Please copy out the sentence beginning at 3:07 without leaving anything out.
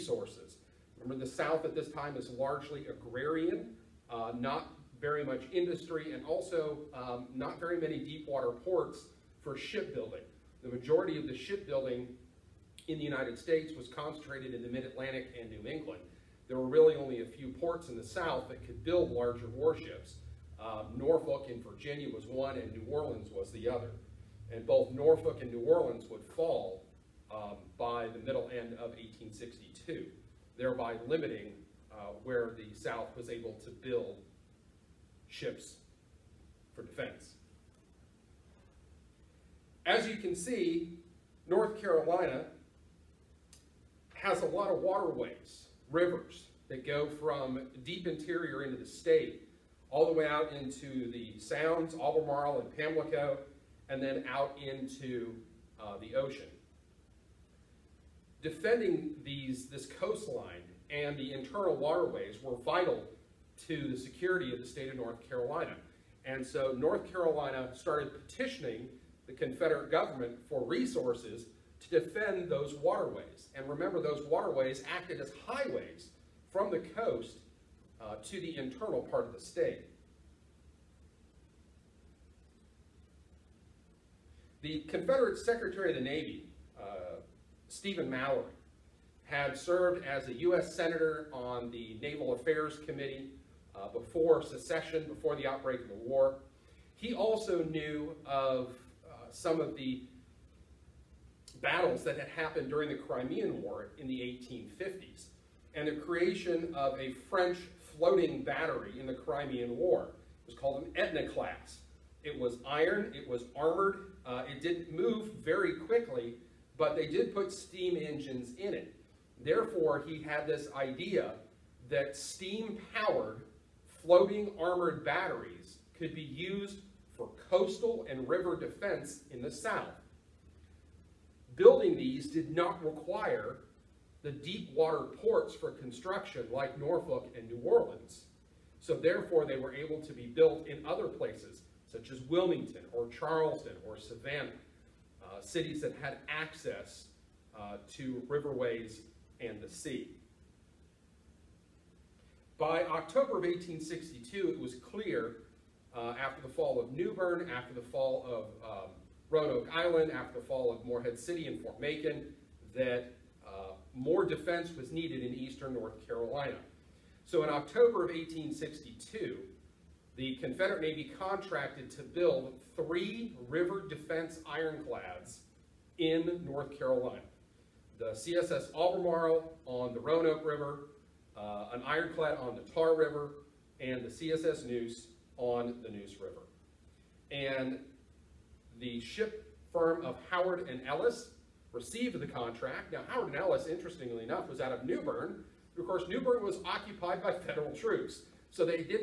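And the ship firm of Howard and Ellis received the contract.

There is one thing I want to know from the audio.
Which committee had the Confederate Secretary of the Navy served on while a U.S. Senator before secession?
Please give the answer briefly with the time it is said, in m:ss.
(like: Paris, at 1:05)
Naval Affairs Committee, at 1:32.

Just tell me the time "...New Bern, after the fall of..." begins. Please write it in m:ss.
2:36.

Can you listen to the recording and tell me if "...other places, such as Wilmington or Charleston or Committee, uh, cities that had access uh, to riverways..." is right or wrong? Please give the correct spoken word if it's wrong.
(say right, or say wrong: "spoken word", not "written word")
wrong: "Savannah", not "Committee".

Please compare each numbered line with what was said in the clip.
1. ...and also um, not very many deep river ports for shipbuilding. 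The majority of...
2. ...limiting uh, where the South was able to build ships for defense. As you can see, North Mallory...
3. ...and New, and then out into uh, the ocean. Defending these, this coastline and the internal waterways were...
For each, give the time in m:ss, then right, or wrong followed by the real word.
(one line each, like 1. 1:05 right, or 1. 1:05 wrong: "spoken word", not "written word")
1. 0:06 wrong: "water", not "river"
2. 0:31 wrong: "Carolina", not "Mallory"
3. 0:52 wrong: "Pamlico", not "New".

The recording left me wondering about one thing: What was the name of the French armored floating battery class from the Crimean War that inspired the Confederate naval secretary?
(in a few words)
Etna.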